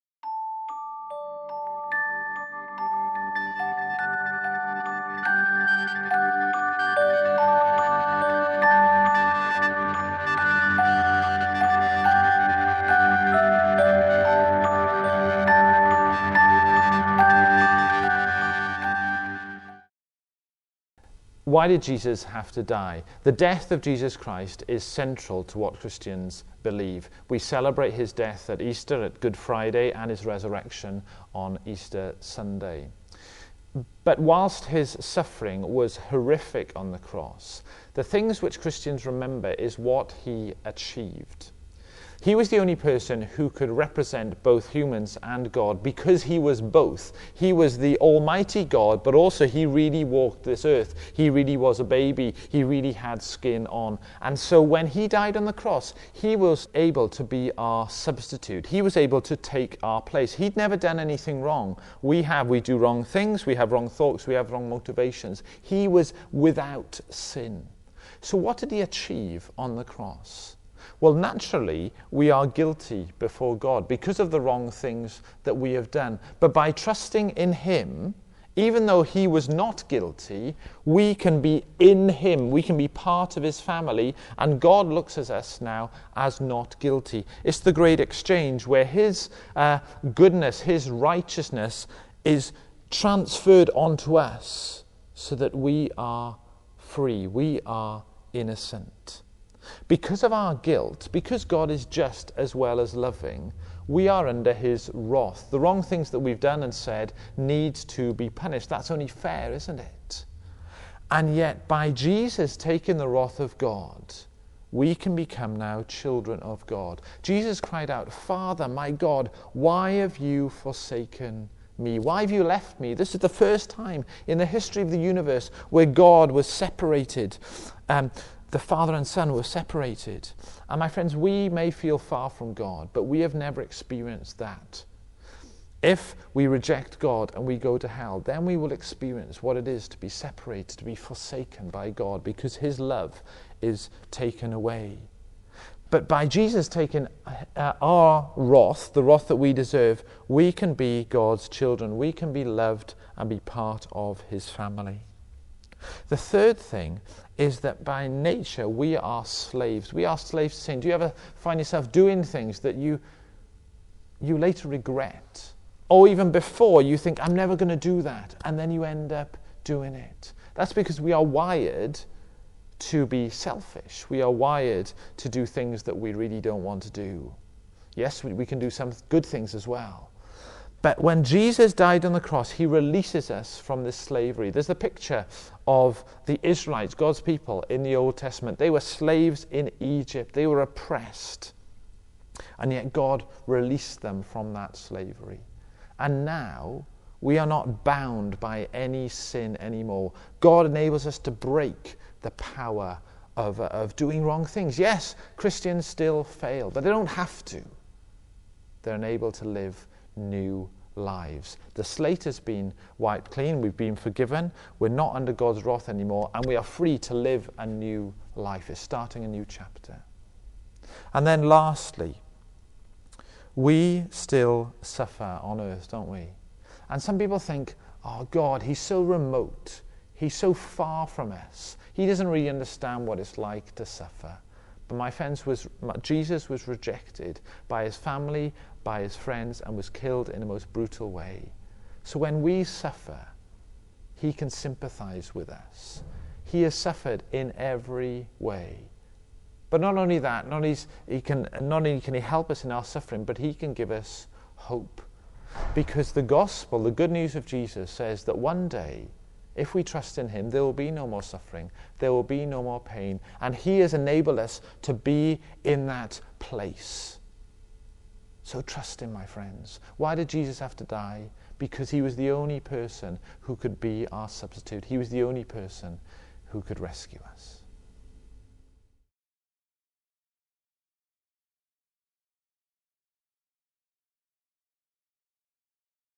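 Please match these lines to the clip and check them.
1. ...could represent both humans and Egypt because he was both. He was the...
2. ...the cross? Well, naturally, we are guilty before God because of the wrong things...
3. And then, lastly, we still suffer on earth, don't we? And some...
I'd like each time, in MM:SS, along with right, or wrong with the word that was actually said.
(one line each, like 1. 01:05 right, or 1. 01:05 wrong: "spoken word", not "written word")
1. 00:43 wrong: "God", not "Egypt"
2. 01:09 right
3. 03:41 right.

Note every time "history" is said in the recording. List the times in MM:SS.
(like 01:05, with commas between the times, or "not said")
02:04.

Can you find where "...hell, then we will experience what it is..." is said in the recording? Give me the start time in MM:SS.
02:17.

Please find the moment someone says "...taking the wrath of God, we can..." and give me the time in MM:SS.
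01:52.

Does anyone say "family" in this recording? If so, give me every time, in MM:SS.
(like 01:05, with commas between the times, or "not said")
01:23, 02:34, 03:57.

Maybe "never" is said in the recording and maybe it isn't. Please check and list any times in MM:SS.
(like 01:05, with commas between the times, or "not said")
01:00, 02:13, 02:47.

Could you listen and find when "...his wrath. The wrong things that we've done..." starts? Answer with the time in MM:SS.
01:44.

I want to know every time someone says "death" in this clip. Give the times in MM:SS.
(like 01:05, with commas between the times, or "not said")
00:23, 00:28.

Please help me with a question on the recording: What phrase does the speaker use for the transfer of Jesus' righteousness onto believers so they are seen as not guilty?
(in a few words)
The great exchange.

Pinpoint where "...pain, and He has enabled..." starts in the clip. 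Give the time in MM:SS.
04:22.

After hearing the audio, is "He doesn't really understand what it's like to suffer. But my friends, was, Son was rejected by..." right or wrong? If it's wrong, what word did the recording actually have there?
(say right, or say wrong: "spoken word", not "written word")
wrong: "Jesus", not "Son".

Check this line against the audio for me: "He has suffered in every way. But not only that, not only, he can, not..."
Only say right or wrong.
right.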